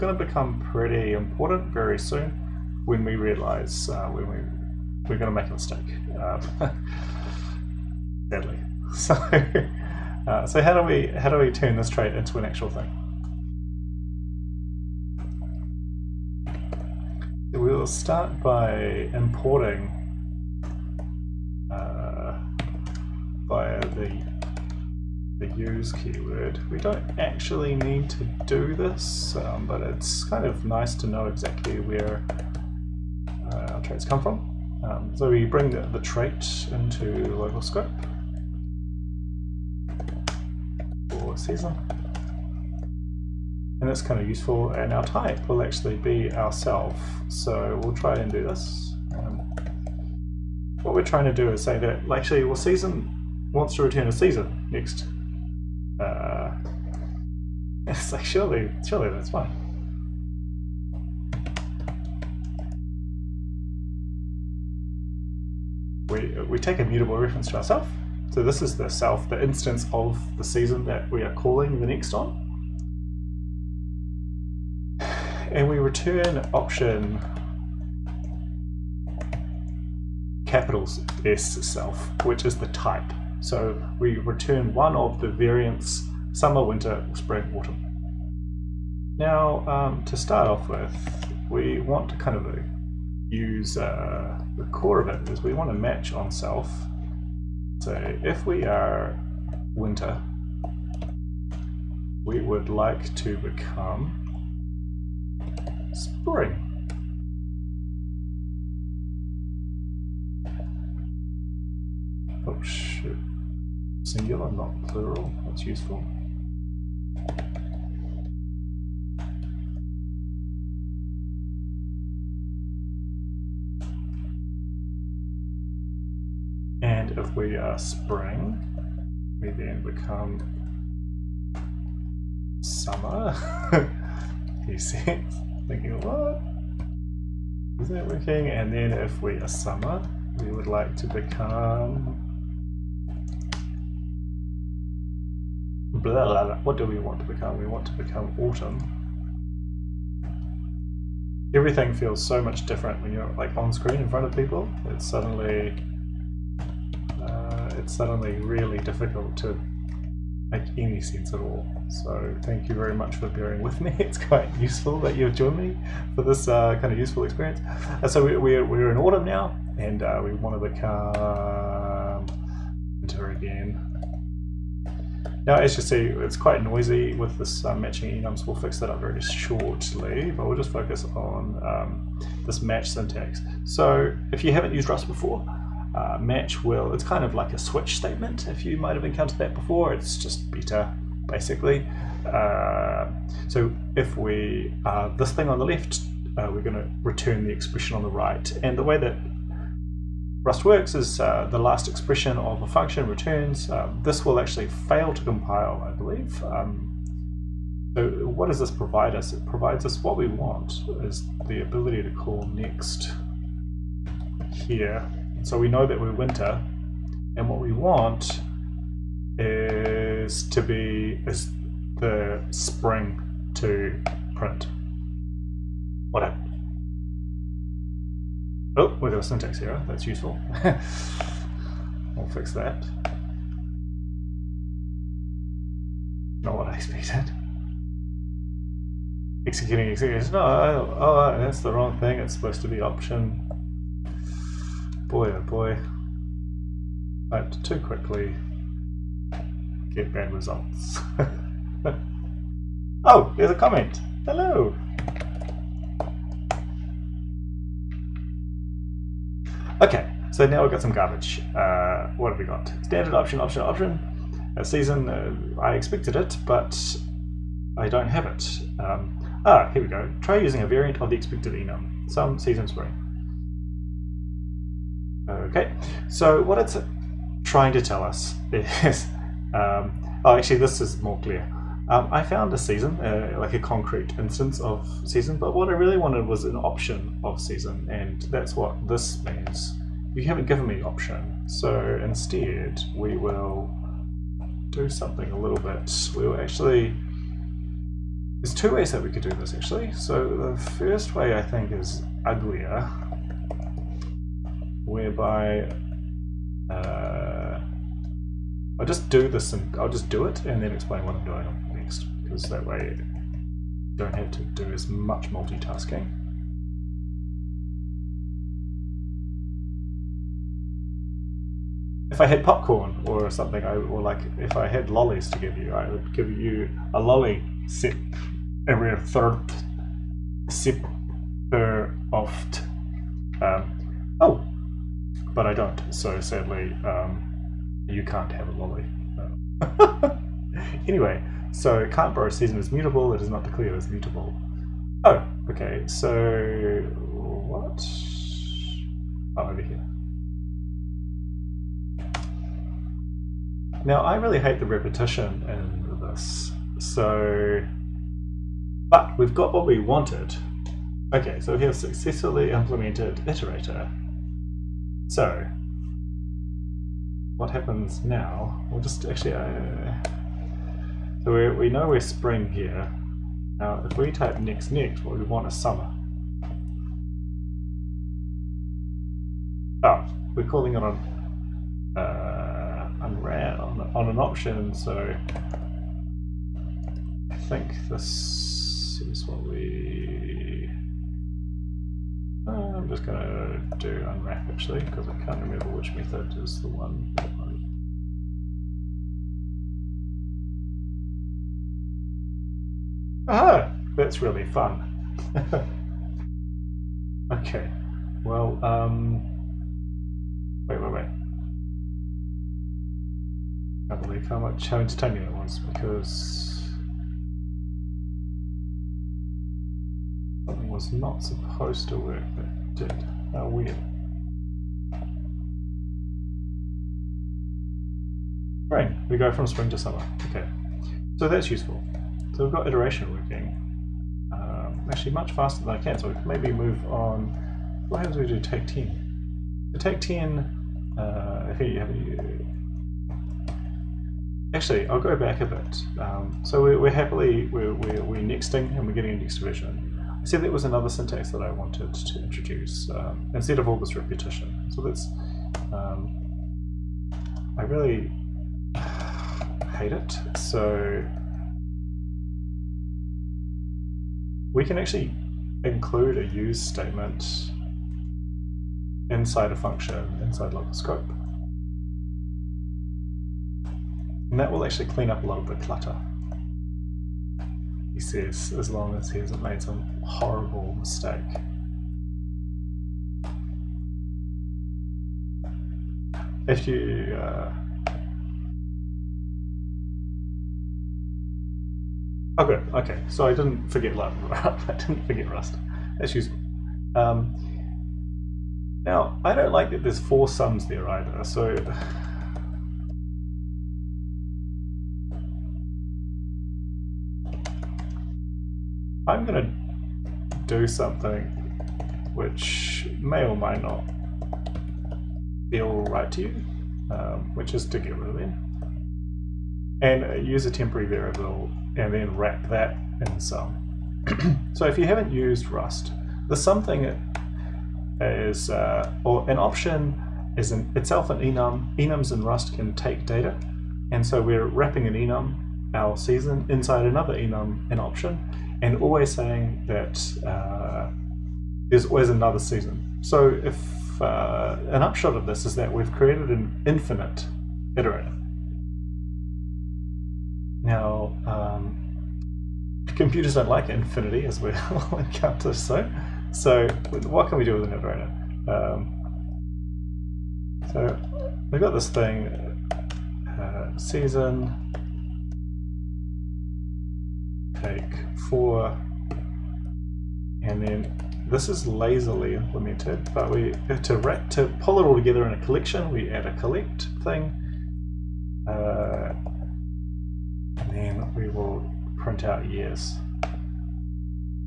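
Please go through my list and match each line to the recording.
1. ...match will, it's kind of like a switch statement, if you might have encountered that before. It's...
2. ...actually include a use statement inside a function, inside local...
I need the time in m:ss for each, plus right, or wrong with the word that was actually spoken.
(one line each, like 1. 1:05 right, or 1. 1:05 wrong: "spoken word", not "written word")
1. 3:06 right
2. 7:44 right.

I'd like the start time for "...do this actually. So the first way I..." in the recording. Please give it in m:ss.
4:59.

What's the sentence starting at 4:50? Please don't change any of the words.
You haven't given me option, so instead we will do something a little bit.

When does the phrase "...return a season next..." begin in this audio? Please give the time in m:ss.
0:53.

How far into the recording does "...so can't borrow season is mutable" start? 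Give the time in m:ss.
5:41.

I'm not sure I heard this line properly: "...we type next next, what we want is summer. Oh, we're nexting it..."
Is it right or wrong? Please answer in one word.
wrong.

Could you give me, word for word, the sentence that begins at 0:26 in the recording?
We don't actually need to do this, um, but it's kind of nice to know exactly where uh, our traits come from.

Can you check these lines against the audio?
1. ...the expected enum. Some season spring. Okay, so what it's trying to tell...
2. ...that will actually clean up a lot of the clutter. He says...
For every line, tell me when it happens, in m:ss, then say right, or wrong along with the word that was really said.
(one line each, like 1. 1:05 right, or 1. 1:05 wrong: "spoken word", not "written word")
1. 4:31 right
2. 7:54 right.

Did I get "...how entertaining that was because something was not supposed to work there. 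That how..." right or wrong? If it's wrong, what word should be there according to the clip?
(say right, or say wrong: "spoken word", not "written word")
right.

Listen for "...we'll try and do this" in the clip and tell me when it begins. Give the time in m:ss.
0:47.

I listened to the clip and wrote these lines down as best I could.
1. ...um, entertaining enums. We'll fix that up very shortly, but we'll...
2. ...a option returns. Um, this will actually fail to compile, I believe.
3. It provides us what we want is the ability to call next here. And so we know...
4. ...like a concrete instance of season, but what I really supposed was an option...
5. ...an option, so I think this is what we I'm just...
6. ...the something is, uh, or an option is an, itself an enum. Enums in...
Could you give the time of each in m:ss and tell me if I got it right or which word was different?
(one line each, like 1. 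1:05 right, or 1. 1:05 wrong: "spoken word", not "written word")
1. 2:57 wrong: "matching", not "entertaining"
2. 3:22 wrong: "function", not "option"
3. 3:29 right
4. 4:43 wrong: "wanted", not "supposed"
5. 6:24 right
6. 8:46 right.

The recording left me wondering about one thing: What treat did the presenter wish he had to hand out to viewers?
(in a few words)
lollies.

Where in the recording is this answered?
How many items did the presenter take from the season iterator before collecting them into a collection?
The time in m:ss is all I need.
9:27.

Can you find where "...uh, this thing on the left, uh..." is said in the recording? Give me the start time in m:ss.
3:14.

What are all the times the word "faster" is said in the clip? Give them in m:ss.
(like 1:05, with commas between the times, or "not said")
7:15.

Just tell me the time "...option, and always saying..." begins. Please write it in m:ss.
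8:57.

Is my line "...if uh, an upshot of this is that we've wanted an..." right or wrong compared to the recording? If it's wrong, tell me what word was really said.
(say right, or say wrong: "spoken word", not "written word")
wrong: "created", not "wanted".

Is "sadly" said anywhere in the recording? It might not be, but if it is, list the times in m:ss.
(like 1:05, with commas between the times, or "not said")
0:08, 5:36.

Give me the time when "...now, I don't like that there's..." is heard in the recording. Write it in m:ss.
8:18.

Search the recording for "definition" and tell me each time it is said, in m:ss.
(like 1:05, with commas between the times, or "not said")
not said.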